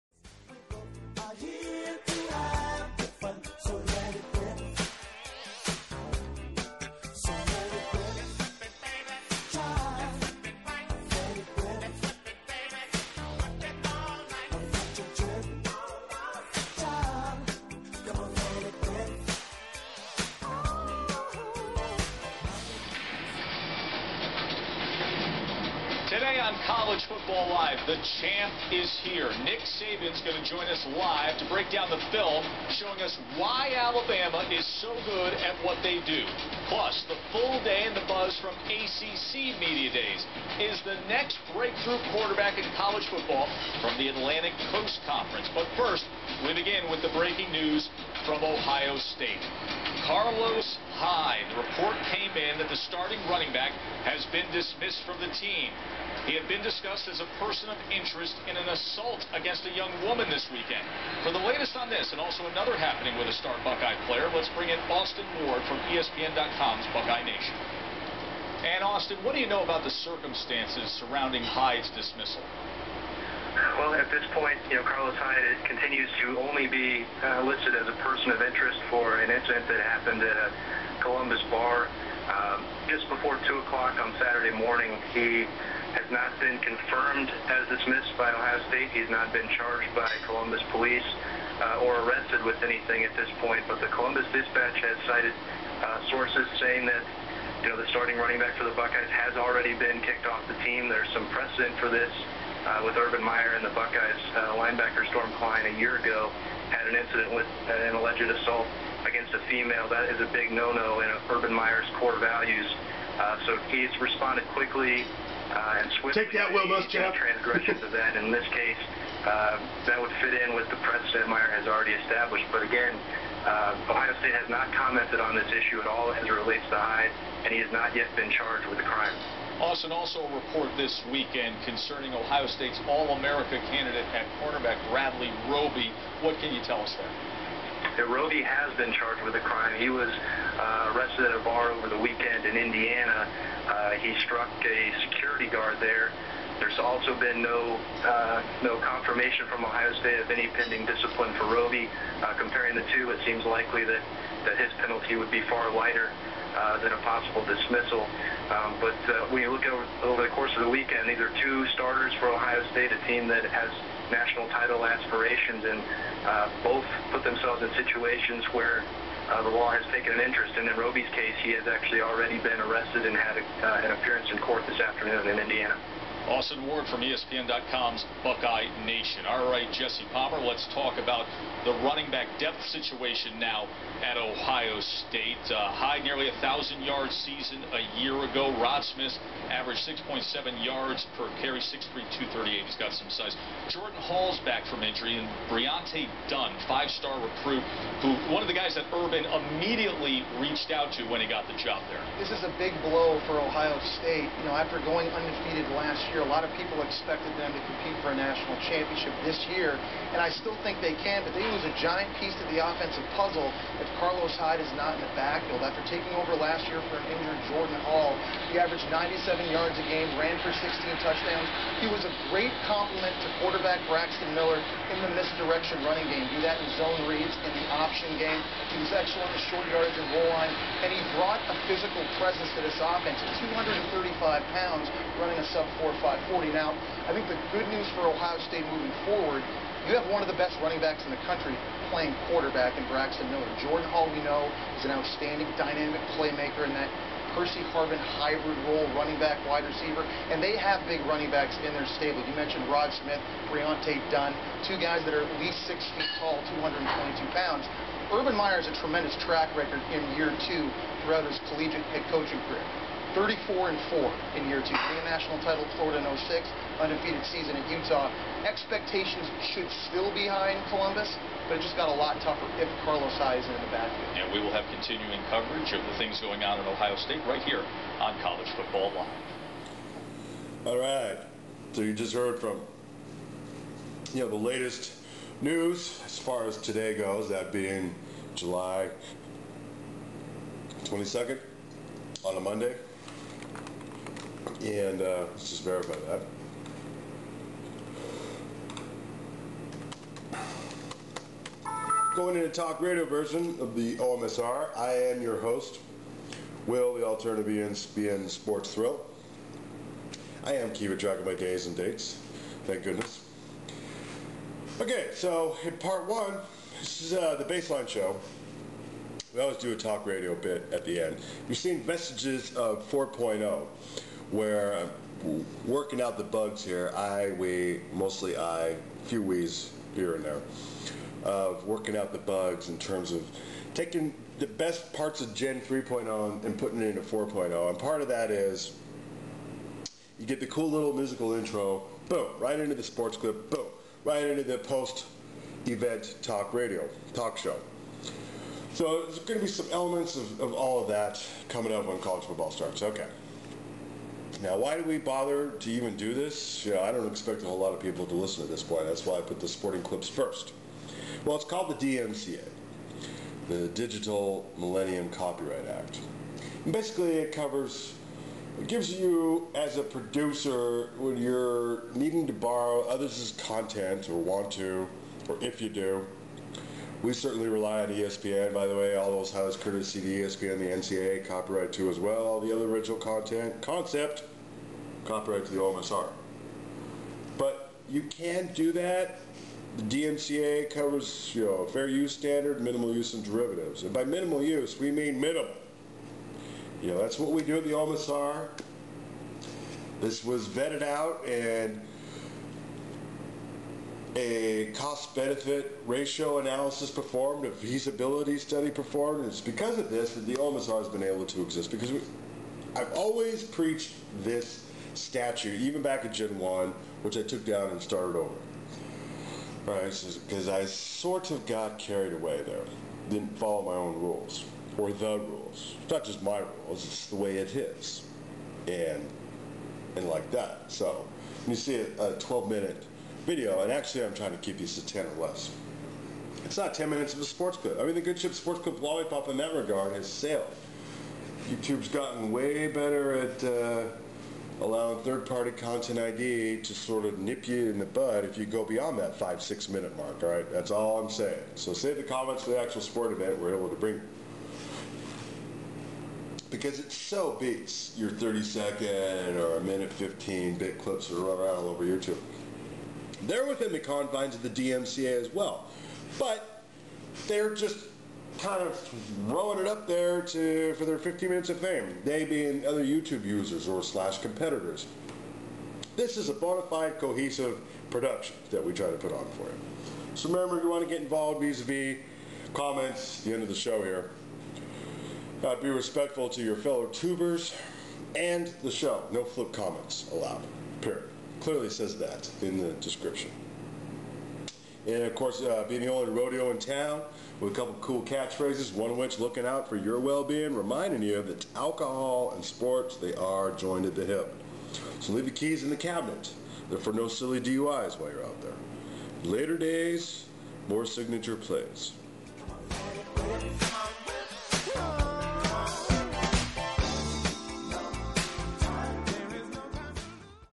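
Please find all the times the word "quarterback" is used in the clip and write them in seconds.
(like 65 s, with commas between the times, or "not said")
42 s, 223 s, 242 s.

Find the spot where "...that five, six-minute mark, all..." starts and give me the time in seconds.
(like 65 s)
448 s.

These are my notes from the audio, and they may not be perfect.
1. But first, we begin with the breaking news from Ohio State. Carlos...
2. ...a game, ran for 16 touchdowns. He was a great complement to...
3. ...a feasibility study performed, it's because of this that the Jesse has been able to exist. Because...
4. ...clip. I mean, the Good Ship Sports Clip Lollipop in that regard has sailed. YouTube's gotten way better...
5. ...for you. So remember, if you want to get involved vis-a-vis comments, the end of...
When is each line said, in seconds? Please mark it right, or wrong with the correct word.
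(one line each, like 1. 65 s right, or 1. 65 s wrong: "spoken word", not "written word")
1. 45 s right
2. 219 s right
3. 407 s wrong: "OMSR", not "Jesse"
4. 437 s right
5. 479 s right.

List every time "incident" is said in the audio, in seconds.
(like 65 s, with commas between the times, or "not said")
79 s, 106 s.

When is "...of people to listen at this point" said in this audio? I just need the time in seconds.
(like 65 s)
357 s.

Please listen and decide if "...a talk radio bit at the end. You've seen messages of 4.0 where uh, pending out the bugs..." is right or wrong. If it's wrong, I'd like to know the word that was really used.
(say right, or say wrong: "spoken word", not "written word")
wrong: "working", not "pending".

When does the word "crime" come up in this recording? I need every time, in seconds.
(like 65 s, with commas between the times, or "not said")
128 s, 139 s.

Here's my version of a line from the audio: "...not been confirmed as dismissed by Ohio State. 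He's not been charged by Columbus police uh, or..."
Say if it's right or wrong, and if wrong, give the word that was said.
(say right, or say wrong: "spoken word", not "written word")
right.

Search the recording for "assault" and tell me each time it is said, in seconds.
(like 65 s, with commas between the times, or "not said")
58 s, 108 s.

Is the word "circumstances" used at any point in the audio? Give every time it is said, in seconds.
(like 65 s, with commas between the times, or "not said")
69 s.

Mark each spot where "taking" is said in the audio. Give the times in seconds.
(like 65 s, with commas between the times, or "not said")
215 s, 333 s.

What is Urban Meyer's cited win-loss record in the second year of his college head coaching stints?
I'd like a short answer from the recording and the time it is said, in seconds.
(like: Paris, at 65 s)
34 and 4, at 263 s.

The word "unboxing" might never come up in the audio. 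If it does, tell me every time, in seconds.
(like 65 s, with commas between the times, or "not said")
not said.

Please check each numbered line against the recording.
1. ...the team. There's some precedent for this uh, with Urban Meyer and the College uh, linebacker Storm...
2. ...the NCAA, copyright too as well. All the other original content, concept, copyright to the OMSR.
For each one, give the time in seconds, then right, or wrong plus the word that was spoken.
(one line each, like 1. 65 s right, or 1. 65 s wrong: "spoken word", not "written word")
1. 100 s wrong: "Buckeyes", not "College"
2. 380 s right.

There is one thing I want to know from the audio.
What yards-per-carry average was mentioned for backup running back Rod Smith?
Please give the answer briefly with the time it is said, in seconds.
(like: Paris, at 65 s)
6.7, at 189 s.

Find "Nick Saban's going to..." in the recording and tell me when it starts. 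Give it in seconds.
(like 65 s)
29 s.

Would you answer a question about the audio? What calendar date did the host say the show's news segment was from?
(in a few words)
July 22nd.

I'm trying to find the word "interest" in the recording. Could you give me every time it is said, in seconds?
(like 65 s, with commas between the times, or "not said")
57 s, 78 s, 170 s.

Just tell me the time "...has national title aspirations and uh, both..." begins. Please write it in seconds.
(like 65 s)
163 s.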